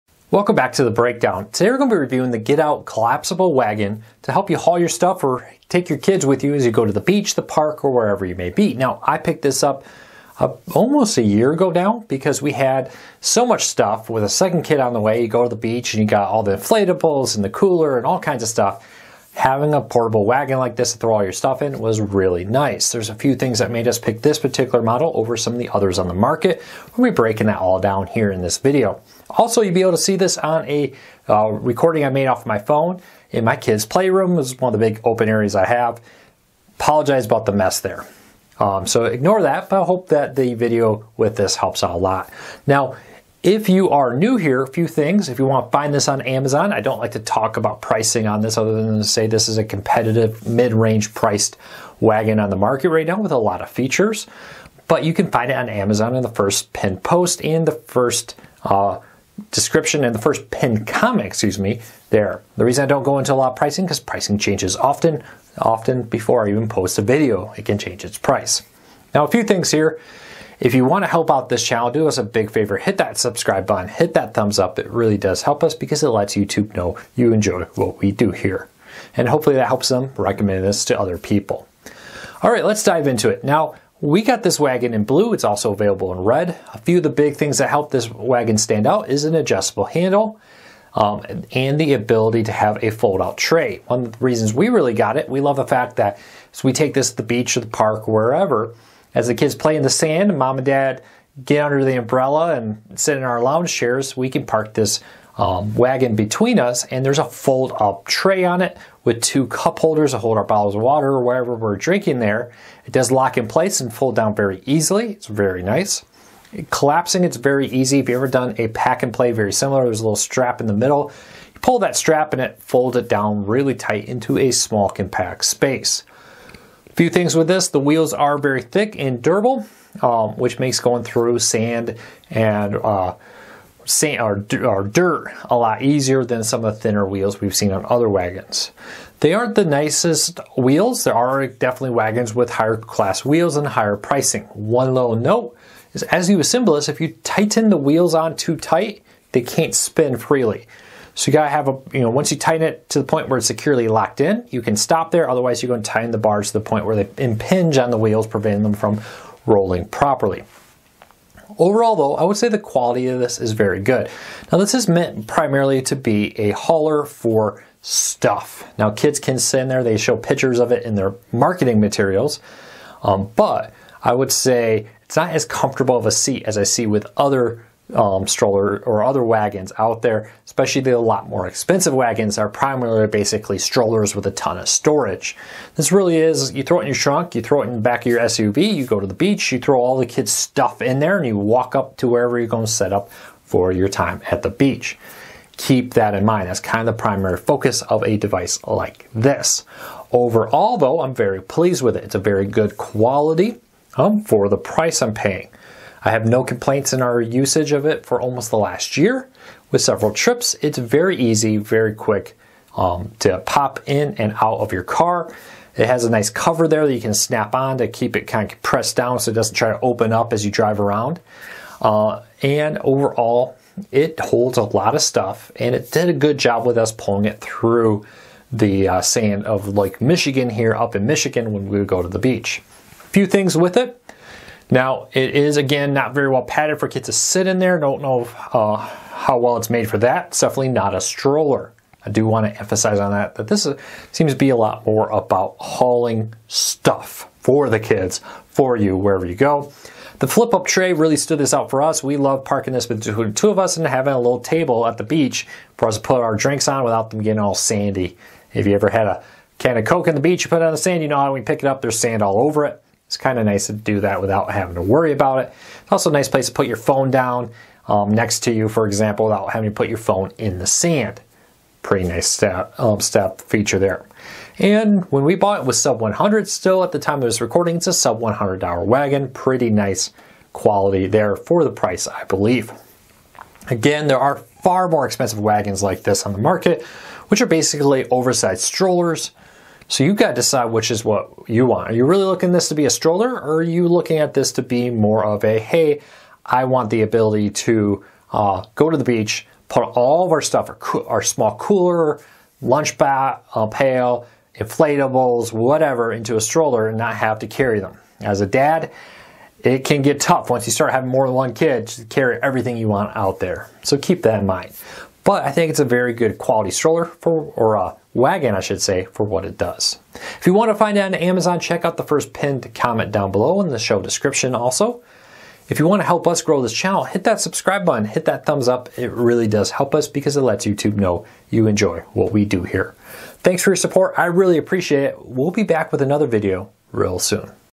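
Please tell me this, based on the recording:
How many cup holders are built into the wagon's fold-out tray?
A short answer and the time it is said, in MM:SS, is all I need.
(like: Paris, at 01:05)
2, at 01:49.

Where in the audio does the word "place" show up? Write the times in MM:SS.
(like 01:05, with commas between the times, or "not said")
01:53, 04:26.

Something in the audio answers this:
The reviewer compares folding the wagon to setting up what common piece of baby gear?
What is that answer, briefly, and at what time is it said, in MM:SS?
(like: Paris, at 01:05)
A pack and play, at 01:58.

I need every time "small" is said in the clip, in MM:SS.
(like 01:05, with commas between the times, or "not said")
02:04, 05:01.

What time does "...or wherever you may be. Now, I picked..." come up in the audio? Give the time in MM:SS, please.
00:07.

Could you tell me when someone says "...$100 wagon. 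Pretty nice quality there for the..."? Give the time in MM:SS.
04:38.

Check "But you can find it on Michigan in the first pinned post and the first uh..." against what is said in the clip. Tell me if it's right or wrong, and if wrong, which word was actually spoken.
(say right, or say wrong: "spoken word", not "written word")
wrong: "Amazon", not "Michigan".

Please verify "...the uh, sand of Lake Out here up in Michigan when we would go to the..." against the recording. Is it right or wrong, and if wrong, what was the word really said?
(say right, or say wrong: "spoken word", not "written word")
wrong: "Michigan", not "Out".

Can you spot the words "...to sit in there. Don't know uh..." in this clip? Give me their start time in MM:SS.
03:57.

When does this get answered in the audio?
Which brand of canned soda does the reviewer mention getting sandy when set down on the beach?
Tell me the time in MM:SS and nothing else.
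04:19.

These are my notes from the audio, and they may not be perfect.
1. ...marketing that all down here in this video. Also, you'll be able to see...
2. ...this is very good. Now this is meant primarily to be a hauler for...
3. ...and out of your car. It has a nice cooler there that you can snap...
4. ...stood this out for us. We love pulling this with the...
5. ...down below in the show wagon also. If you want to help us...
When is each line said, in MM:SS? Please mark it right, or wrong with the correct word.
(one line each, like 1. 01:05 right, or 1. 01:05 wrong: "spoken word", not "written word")
1. 00:27 wrong: "breaking", not "marketing"
2. 02:43 right
3. 03:34 wrong: "cover", not "cooler"
4. 04:11 wrong: "parking", not "pulling"
5. 05:23 wrong: "description", not "wagon".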